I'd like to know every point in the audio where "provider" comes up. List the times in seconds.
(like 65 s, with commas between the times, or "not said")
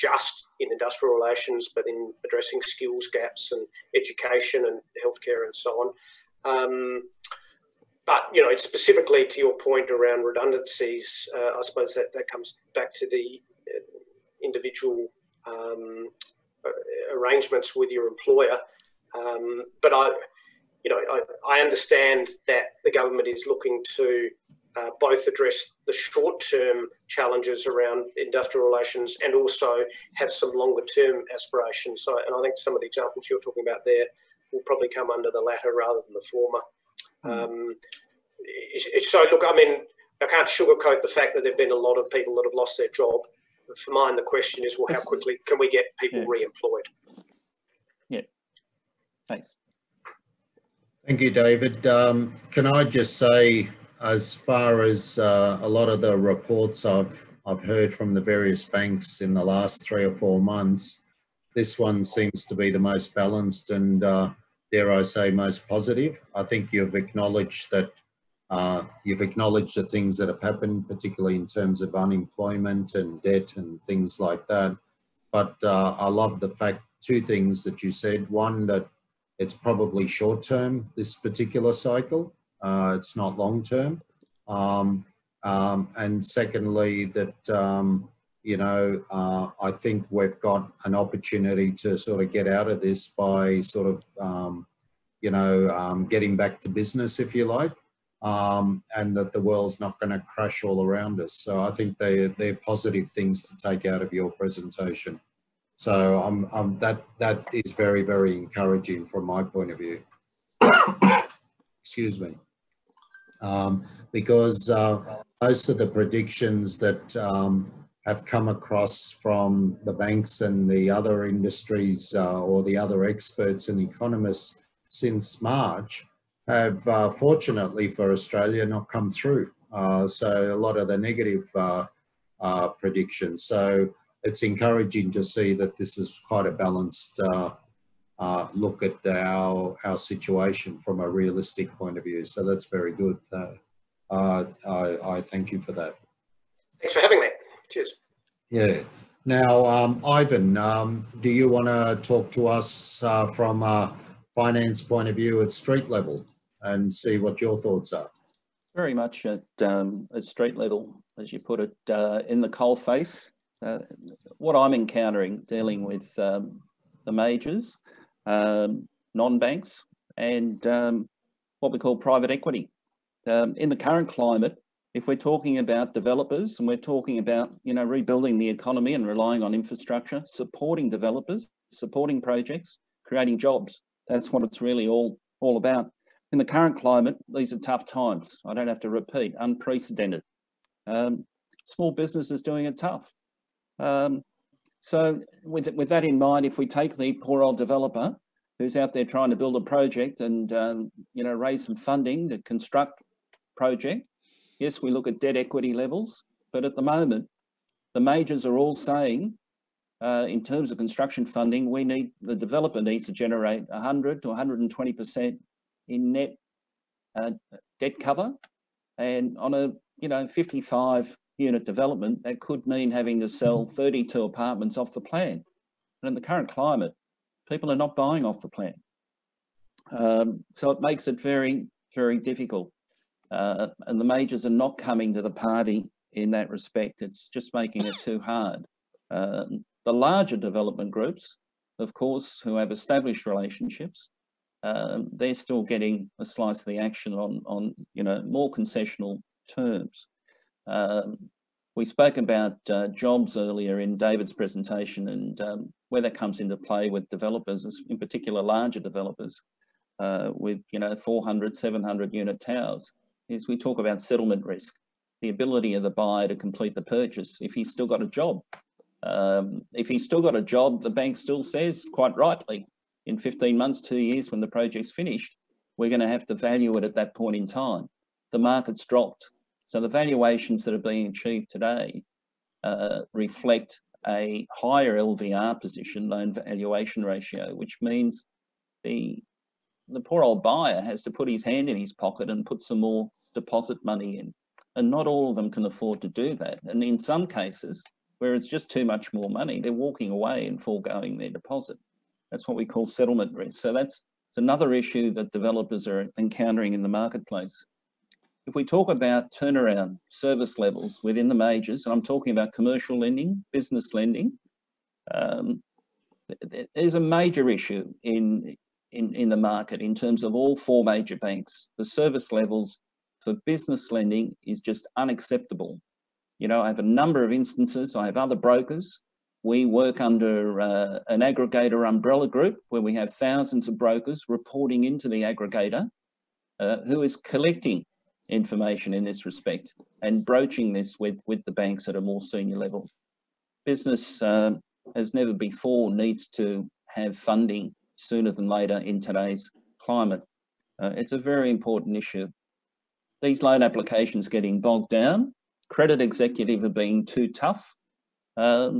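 not said.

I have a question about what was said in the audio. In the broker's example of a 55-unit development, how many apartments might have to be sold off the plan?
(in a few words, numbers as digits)
32.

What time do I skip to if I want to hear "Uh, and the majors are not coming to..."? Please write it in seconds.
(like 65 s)
233 s.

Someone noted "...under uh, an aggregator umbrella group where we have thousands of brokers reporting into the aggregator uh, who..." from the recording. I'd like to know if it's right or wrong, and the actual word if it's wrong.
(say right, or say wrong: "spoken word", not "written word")
right.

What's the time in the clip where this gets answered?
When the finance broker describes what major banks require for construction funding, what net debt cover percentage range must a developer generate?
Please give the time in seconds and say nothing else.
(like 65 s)
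213 s.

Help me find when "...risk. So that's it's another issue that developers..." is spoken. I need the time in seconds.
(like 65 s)
303 s.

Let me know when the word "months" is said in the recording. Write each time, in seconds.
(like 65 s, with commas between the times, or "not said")
60 s, 273 s.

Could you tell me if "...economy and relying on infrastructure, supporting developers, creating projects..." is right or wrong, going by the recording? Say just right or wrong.
wrong.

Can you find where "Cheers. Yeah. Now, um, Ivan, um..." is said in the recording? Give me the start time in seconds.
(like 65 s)
147 s.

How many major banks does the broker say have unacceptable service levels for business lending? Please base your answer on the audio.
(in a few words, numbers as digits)
4.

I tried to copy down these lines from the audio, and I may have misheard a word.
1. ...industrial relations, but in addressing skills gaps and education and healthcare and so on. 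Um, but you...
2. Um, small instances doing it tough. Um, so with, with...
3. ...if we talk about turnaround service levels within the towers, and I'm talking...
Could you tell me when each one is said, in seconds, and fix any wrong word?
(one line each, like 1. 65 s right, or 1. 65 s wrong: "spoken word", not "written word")
1. 0 s right
2. 190 s wrong: "businesses", not "instances"
3. 308 s wrong: "majors", not "towers".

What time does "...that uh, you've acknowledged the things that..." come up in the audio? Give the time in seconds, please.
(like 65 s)
67 s.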